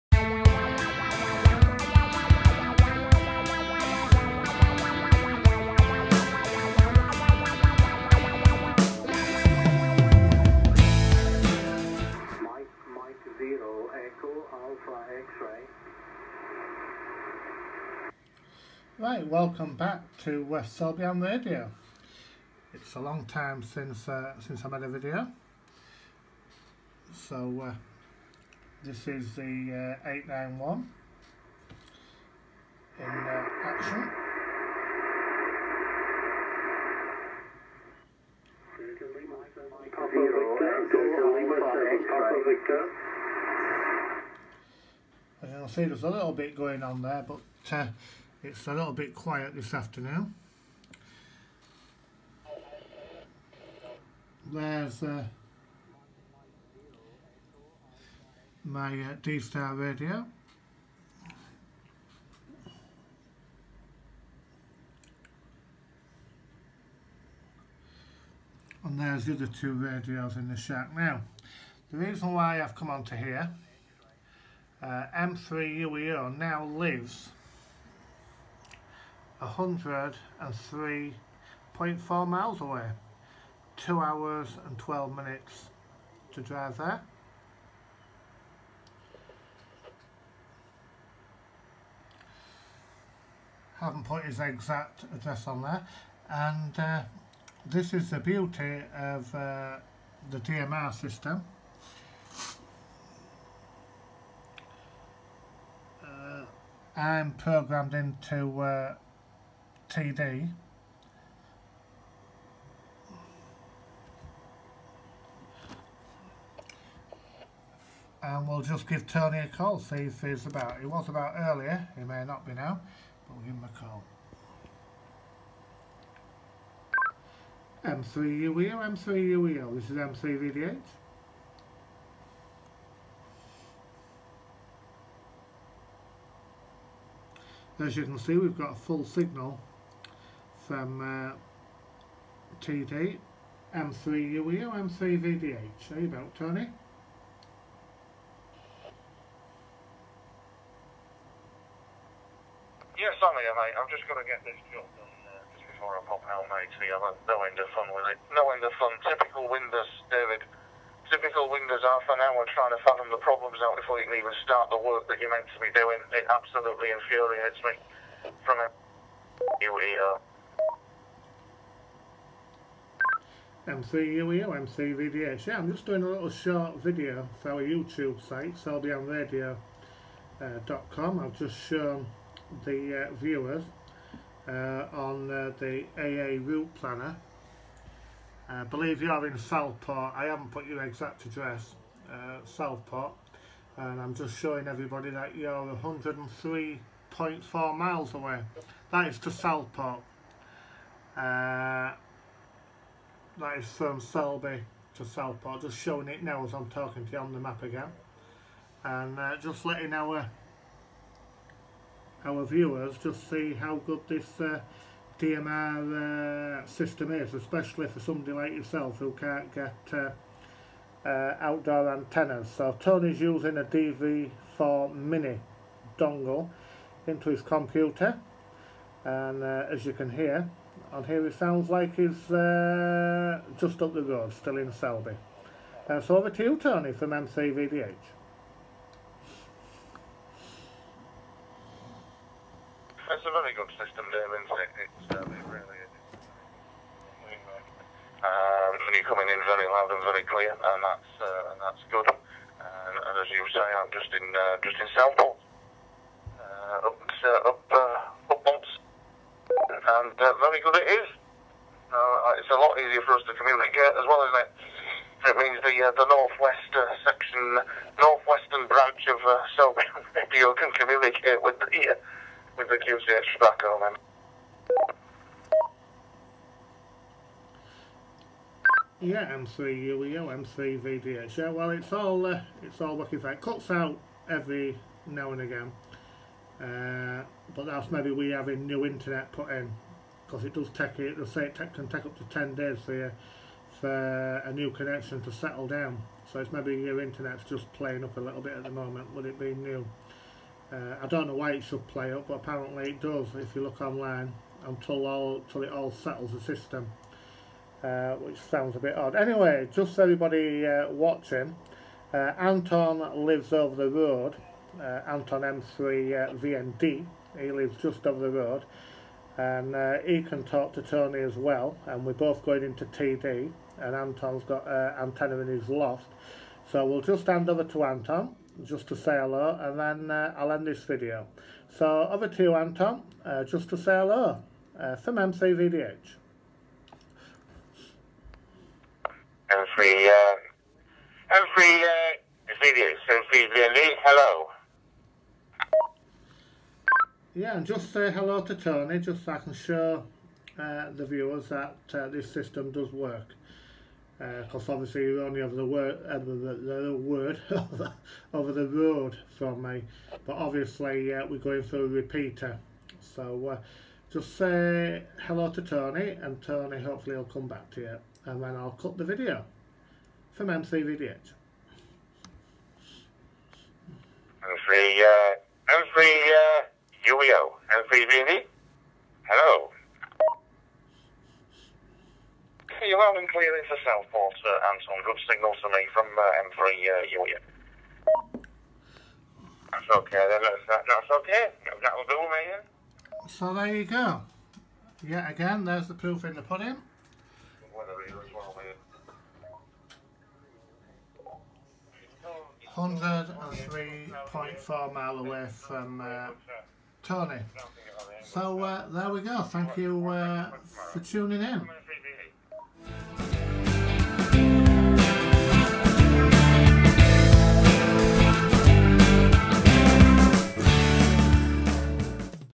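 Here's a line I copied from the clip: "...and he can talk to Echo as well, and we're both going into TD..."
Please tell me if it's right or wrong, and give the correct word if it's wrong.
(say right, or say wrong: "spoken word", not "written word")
wrong: "Tony", not "Echo".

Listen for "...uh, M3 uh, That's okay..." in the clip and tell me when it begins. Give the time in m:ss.
6:26.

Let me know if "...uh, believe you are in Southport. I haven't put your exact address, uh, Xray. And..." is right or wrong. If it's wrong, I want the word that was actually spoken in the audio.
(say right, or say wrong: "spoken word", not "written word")
wrong: "Southport", not "Xray".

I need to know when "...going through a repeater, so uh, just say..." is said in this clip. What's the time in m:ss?
6:01.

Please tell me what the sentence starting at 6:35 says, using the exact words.
Yet again, there's the proof in the pudding.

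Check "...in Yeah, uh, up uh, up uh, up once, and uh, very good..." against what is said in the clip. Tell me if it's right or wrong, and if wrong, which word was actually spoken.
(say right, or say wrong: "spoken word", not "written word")
wrong: "Southport", not "Yeah".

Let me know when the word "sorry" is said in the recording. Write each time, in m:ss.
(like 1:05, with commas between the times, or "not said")
2:33.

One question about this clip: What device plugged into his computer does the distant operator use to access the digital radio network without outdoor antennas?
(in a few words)
DV4 mini dongle.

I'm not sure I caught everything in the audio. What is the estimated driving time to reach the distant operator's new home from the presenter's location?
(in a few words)
2 hours and 12 minutes.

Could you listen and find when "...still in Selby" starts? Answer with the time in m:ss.
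3:54.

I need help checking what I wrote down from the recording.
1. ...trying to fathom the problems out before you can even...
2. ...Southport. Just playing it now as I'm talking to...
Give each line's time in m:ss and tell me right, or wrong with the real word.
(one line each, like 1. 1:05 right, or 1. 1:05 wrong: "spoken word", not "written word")
1. 2:42 right
2. 3:25 wrong: "showing", not "playing".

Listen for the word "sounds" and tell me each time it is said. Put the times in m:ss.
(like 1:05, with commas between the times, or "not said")
3:51, 5:08.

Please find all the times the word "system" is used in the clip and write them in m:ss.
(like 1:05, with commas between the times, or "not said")
1:40, 3:36, 4:03, 5:06, 5:52.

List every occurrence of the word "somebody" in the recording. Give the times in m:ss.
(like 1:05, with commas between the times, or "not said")
3:37.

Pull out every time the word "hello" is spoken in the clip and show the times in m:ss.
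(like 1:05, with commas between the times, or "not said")
5:29, 5:33, 5:44, 5:48, 6:05, 6:19.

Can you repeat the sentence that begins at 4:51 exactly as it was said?
They say it take, can take up to ten days for, for a new connection to settle down.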